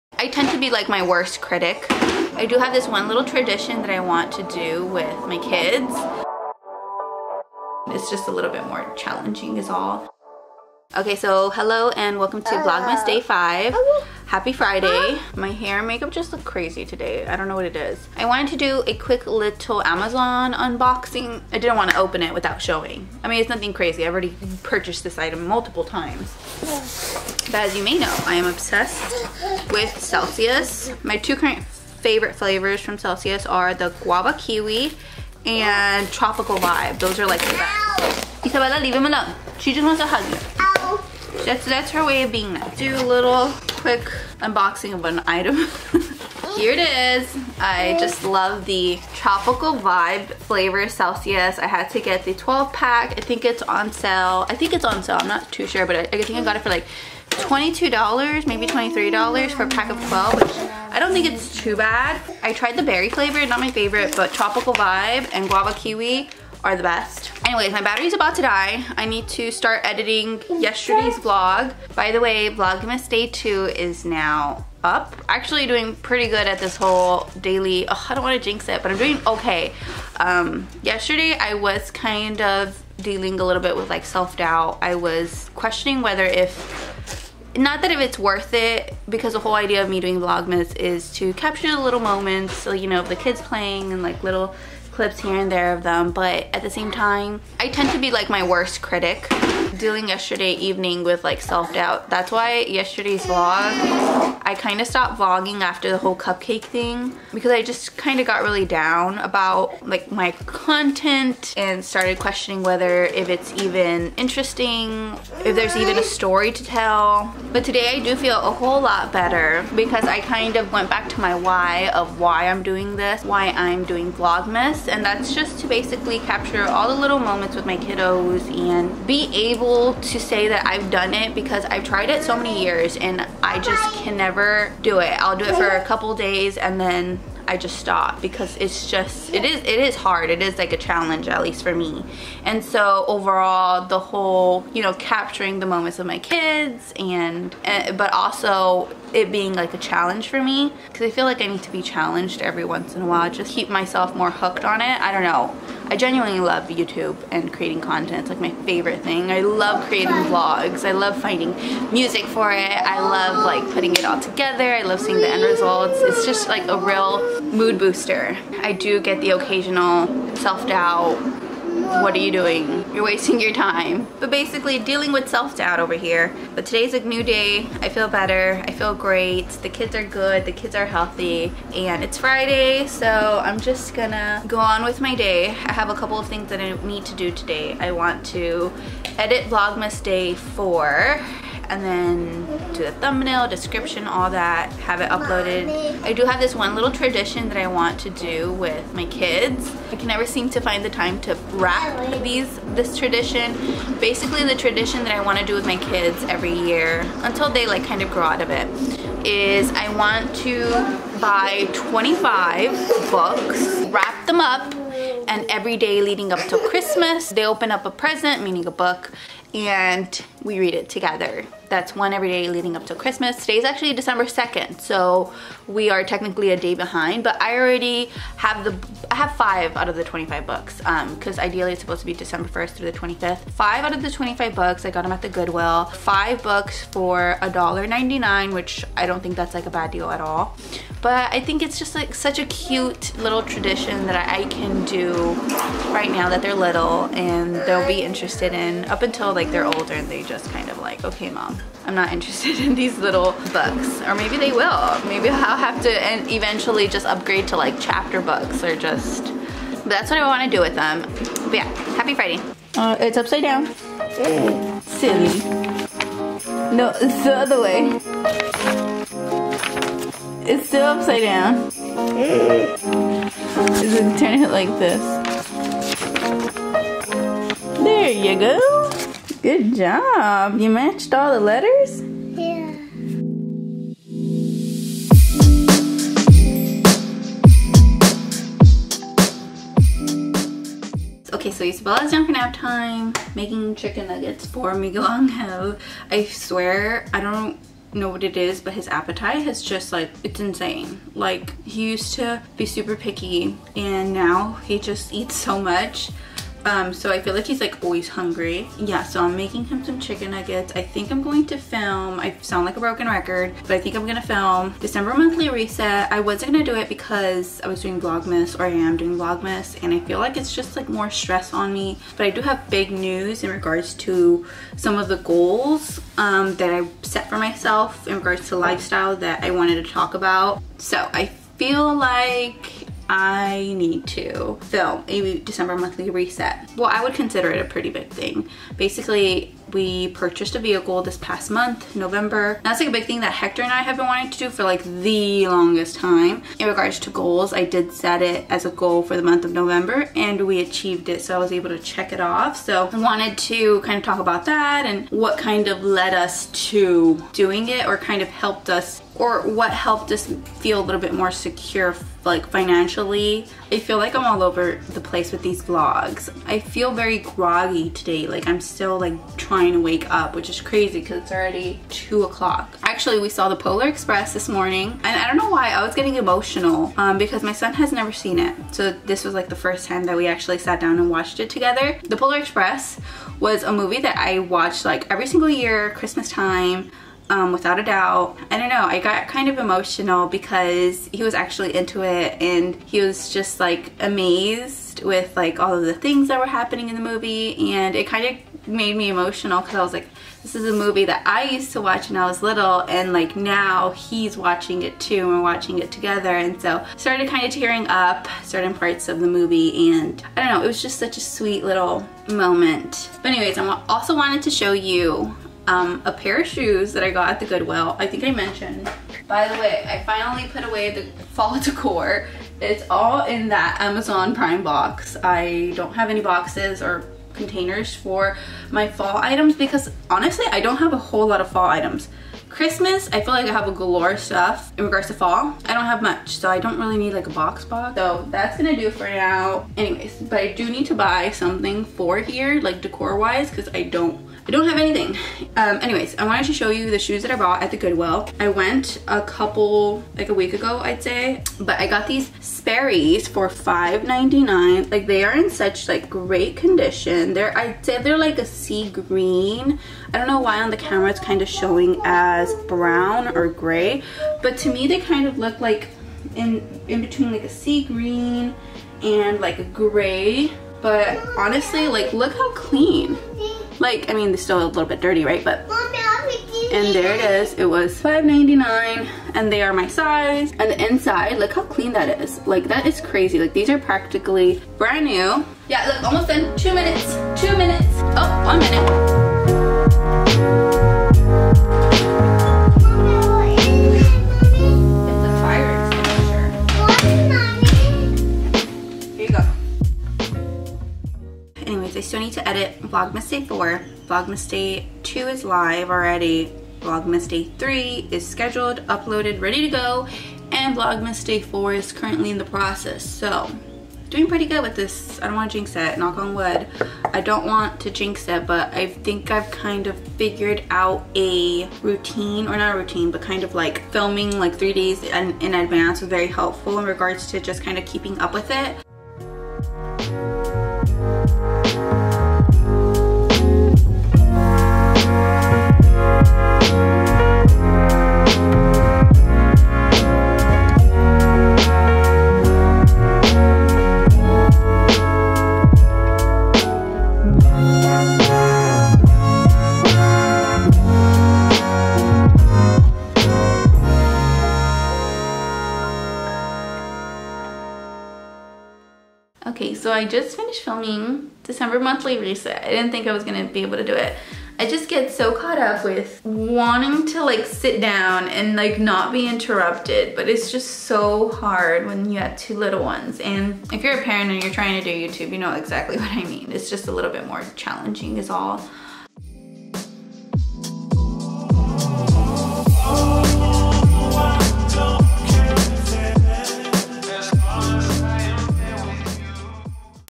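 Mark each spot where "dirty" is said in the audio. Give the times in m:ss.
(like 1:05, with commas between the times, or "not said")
7:55.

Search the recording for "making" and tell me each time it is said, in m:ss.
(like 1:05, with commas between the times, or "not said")
4:53, 5:09.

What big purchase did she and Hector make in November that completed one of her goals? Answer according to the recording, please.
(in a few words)
a vehicle.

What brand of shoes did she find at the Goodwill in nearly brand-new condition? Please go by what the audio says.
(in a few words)
Sperry's.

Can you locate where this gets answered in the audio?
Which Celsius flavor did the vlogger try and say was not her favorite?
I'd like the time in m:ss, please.
1:02.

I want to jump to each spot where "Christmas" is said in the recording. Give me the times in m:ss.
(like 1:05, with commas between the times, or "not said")
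3:36, 3:42, 6:25, 7:12.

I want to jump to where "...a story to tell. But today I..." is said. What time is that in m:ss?
1:55.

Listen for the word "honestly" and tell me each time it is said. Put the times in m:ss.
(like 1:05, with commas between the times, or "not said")
7:10, 7:51.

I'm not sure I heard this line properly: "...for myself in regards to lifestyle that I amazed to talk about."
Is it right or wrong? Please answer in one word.
wrong.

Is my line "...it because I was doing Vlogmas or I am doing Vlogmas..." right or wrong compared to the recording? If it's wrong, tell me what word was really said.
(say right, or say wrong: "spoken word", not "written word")
right.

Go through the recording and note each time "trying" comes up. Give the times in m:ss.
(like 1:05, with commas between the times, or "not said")
6:09, 9:34.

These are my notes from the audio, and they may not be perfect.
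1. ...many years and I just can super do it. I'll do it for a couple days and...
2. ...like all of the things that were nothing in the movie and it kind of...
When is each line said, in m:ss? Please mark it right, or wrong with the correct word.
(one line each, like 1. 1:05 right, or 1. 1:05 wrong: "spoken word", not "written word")
1. 2:12 wrong: "never", not "super"
2. 6:35 wrong: "happening", not "nothing".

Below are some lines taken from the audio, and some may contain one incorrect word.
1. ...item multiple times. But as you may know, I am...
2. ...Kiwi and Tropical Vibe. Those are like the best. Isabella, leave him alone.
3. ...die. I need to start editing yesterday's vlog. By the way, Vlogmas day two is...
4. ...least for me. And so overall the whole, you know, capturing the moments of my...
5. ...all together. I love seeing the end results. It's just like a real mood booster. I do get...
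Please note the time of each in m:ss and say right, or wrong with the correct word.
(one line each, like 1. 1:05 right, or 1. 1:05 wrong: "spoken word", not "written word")
1. 0:25 right
2. 0:34 right
3. 1:08 right
4. 2:21 right
5. 2:44 right.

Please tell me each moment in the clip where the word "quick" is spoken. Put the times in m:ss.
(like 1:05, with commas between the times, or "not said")
0:18, 0:43.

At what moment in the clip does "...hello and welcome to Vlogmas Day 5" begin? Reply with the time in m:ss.
0:11.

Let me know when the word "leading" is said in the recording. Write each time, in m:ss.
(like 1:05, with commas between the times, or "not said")
3:36, 3:42.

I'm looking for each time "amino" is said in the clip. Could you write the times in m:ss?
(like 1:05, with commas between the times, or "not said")
not said.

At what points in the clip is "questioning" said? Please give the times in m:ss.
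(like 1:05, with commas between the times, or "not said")
1:25, 1:52.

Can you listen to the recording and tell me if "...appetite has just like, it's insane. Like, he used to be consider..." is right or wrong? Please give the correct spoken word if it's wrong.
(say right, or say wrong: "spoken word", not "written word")
wrong: "super", not "consider".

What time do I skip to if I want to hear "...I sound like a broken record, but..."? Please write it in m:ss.
5:12.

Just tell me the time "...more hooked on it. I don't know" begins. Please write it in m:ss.
2:34.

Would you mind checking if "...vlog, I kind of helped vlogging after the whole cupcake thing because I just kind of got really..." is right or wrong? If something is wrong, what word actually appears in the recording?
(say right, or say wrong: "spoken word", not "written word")
wrong: "stopped", not "helped".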